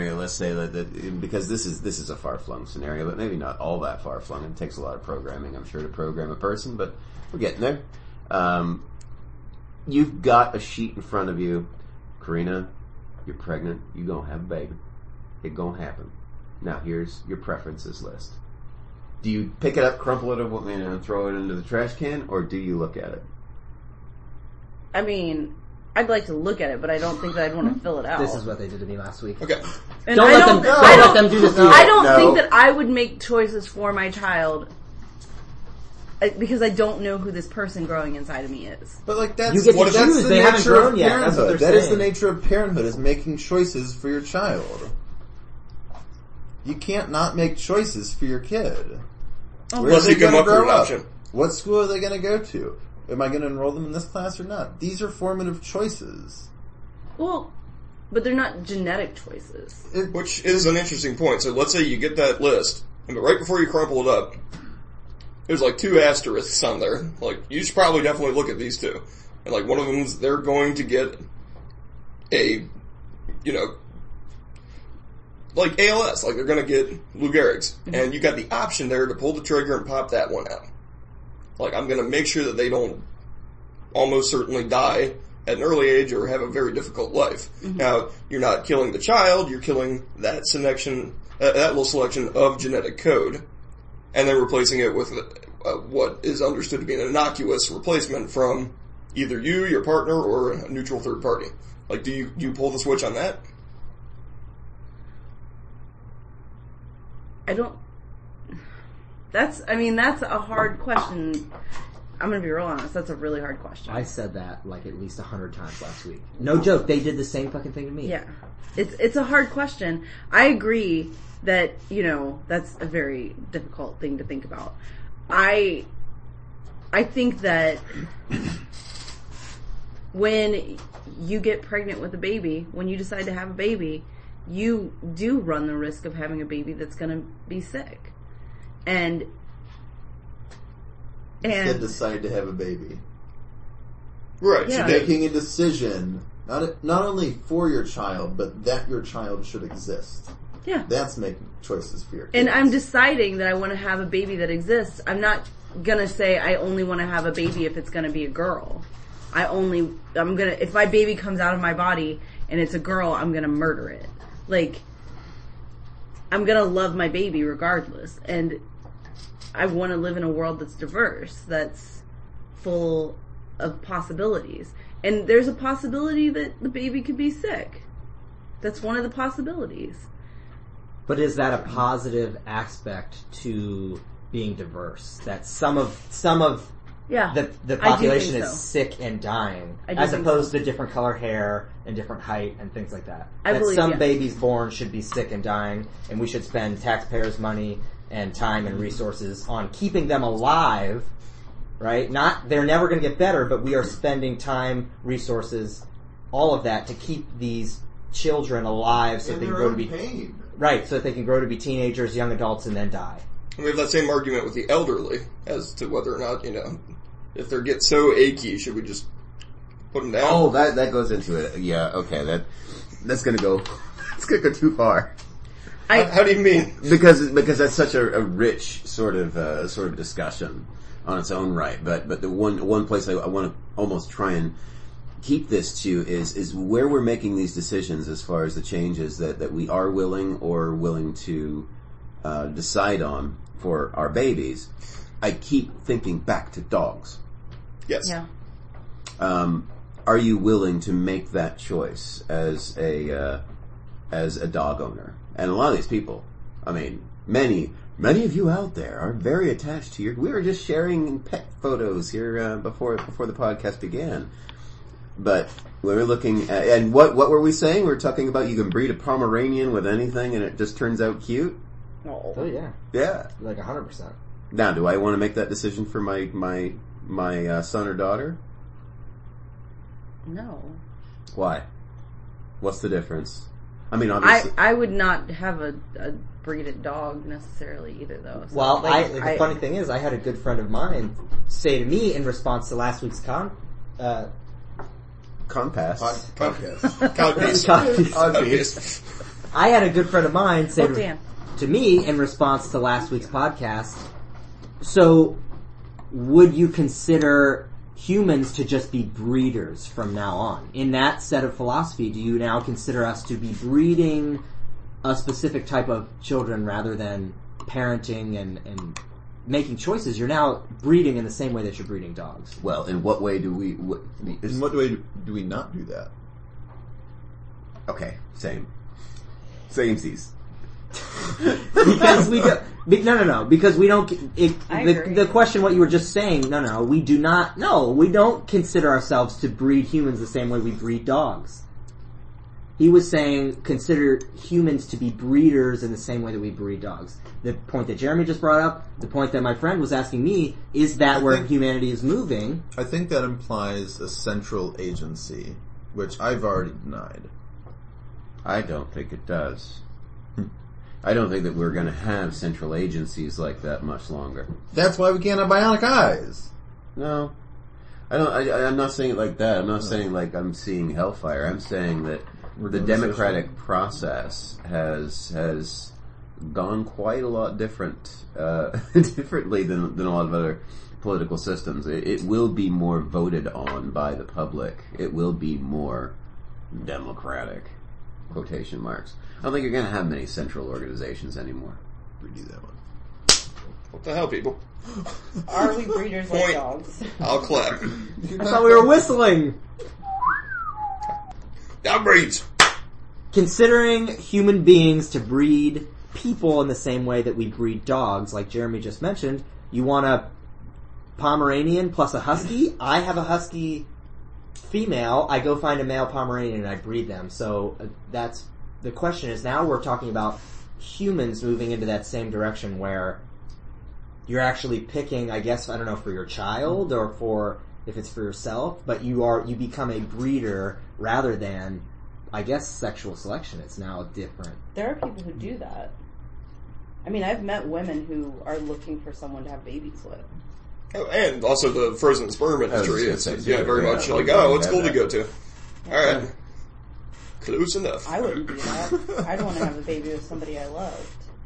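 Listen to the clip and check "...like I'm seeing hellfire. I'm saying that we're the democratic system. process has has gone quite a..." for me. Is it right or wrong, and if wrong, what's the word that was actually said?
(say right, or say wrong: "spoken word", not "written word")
right.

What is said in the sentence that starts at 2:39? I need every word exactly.
I only I'm going to if my baby comes out of my body and it's a girl, I'm going to murder it.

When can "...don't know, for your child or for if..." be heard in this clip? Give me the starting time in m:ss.
7:05.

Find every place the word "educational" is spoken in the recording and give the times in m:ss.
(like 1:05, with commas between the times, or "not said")
not said.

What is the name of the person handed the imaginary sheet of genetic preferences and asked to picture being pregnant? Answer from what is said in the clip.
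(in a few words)
Karina.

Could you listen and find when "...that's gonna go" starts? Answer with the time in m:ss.
3:43.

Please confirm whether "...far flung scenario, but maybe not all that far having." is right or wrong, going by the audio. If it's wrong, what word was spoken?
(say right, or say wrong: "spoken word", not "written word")
wrong: "flung", not "having".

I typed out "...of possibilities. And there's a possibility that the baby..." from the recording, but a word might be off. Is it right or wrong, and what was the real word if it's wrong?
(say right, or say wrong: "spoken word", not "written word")
right.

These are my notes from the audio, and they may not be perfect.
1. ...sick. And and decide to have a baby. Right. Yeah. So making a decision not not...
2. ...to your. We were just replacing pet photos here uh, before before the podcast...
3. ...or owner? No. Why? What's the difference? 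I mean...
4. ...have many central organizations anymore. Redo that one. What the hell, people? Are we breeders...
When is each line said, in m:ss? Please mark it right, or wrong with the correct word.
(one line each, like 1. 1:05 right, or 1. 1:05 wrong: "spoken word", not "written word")
1. 2:17 right
2. 4:19 wrong: "sharing", not "replacing"
3. 4:37 wrong: "daughter", not "owner"
4. 6:29 right.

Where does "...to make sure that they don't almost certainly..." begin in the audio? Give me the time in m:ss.
1:22.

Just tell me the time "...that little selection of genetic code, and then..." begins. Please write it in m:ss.
1:31.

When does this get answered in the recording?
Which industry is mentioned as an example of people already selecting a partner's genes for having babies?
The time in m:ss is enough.
7:21.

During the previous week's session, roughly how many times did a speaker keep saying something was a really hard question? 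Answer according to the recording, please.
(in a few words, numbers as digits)
100.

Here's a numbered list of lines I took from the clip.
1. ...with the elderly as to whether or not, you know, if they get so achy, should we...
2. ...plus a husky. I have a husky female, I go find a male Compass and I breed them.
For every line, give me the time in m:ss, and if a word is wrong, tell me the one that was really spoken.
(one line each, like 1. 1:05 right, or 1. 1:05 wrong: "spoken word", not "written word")
1. 3:34 right
2. 6:51 wrong: "Pomeranian", not "Compass".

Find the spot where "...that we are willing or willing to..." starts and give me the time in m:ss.
3:59.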